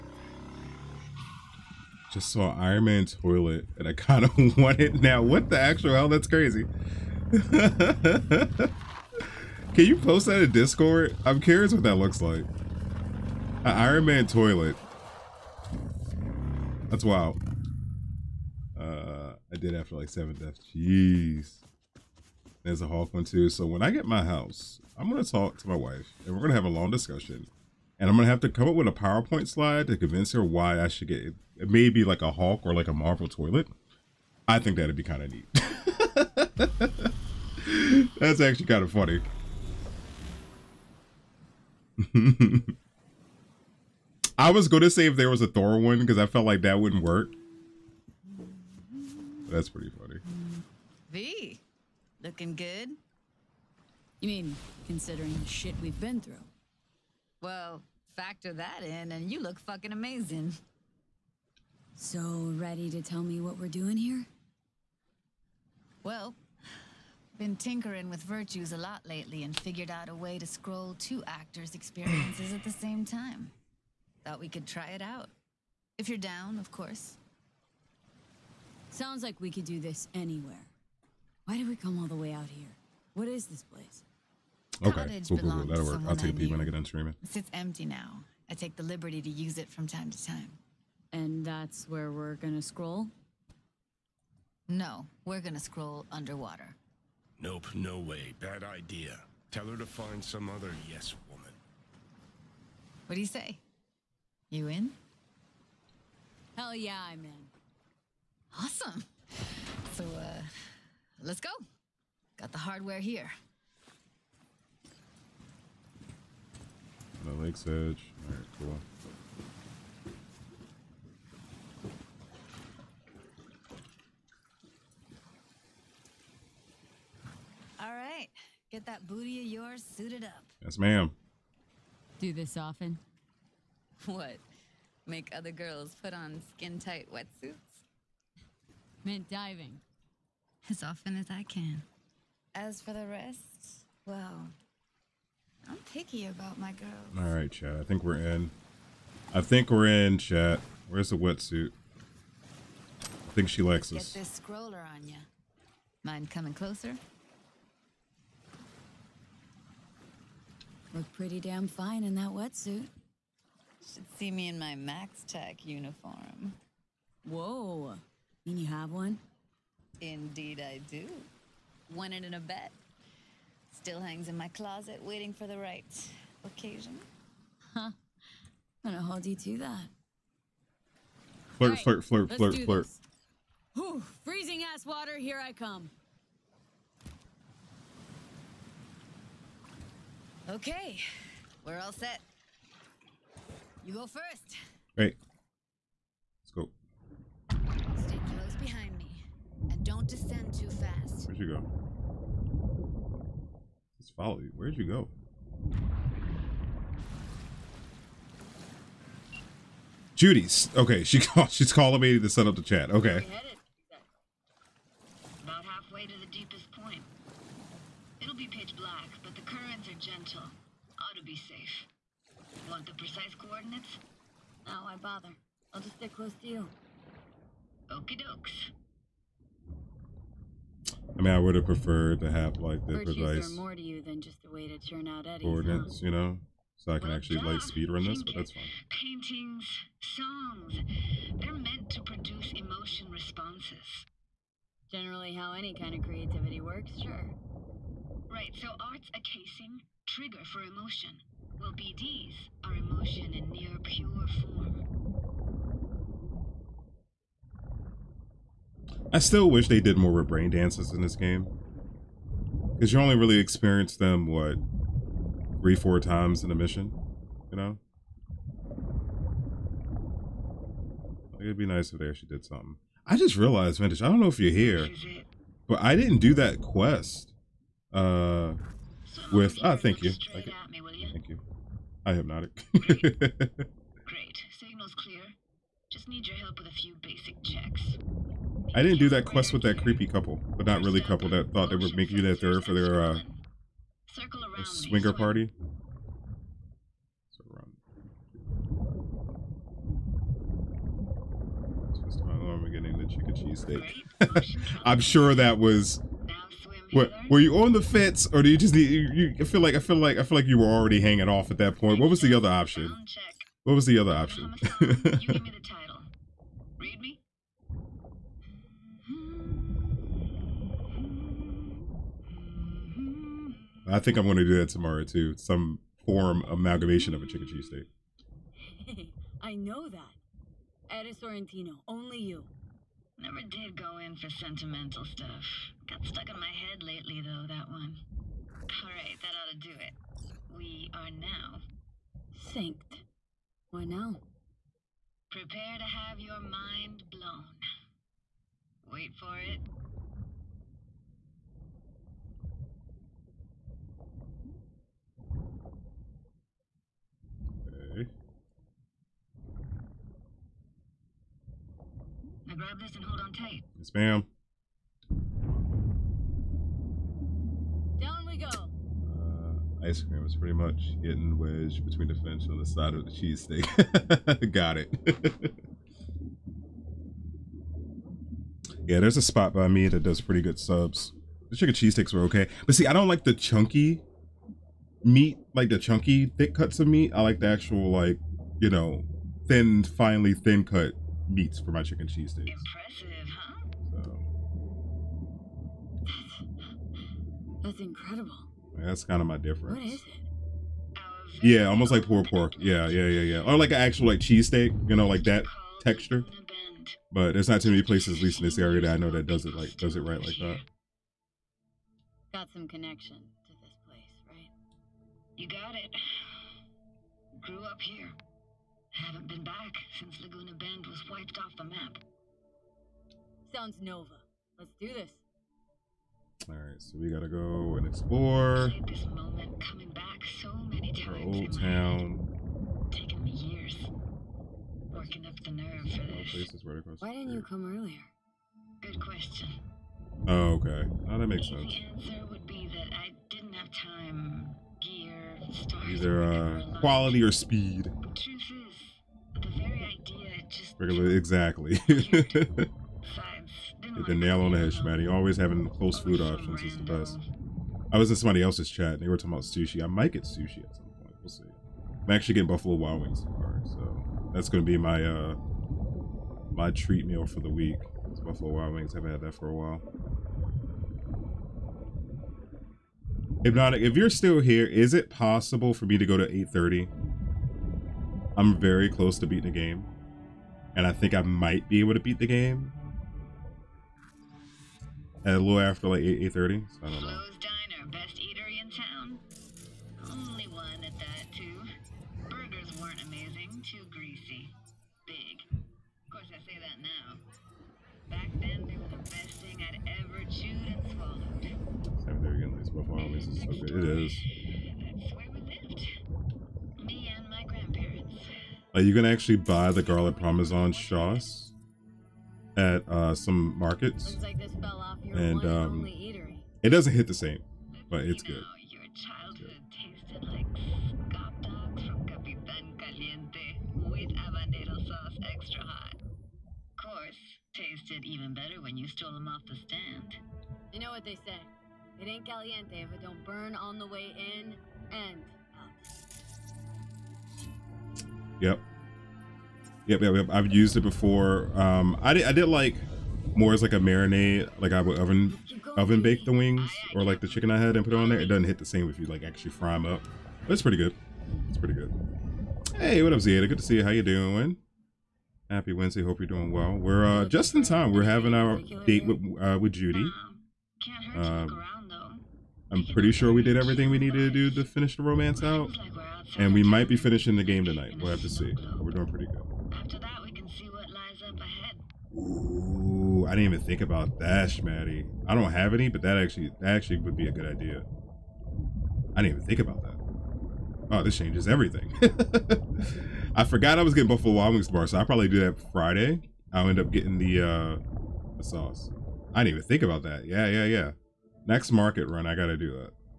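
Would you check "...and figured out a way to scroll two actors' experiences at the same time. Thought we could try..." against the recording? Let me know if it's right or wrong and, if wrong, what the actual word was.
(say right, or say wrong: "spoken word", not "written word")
right.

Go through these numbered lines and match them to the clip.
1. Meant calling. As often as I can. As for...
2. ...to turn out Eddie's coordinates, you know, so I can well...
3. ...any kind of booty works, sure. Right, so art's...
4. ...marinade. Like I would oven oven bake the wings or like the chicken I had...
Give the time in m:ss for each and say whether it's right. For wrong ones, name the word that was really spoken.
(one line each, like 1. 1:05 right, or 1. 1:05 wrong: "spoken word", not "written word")
1. 2:19 wrong: "diving", not "calling"
2. 3:54 right
3. 4:05 wrong: "creativity", not "booty"
4. 9:03 right.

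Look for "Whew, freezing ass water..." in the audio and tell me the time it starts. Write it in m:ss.
3:03.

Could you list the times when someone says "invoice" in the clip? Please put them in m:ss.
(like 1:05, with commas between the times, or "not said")
not said.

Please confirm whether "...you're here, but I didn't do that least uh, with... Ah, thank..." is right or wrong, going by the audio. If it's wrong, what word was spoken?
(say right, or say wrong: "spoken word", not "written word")
wrong: "quest", not "least".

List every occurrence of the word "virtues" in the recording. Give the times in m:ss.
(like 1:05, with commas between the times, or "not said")
1:08, 3:52.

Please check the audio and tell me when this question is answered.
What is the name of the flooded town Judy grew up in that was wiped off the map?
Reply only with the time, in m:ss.
7:00.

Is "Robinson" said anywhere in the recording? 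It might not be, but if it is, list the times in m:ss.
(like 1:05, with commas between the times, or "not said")
not said.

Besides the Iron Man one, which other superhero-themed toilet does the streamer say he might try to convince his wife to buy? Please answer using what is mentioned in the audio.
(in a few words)
Hulk.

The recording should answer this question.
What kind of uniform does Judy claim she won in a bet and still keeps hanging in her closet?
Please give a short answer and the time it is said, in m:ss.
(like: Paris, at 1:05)
MaxTac uniform, at 2:44.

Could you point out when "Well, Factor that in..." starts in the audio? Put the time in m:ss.
0:57.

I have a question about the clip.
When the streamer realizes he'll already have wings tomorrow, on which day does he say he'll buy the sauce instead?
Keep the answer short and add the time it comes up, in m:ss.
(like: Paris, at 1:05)
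Friday, at 9:45.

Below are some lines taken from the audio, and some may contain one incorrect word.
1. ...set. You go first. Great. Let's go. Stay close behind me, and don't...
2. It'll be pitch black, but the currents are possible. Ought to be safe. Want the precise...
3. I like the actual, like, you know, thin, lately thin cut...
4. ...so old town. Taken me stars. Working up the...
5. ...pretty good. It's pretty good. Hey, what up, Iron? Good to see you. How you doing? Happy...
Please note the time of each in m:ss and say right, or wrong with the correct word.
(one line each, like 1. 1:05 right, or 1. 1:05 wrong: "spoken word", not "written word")
1. 3:11 right
2. 3:38 wrong: "gentle", not "possible"
3. 6:27 wrong: "finely", not "lately"
4. 7:10 wrong: "years", not "stars"
5. 9:10 wrong: "Zeta", not "Iron".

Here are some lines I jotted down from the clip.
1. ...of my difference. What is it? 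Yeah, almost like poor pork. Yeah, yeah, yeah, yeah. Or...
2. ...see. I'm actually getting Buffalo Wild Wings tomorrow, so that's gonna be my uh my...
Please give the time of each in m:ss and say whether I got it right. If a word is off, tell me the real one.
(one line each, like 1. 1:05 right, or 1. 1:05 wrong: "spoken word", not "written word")
1. 6:39 right
2. 7:41 right.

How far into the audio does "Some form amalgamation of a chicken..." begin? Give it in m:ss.
5:25.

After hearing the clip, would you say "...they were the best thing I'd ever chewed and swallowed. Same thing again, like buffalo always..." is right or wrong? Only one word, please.
right.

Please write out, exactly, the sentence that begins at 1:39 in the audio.
Tell her to find some other yes woman.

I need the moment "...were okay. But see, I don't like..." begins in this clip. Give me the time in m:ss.
6:22.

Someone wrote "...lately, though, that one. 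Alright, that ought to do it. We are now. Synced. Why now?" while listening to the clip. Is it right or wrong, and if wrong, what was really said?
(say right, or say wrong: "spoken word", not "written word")
right.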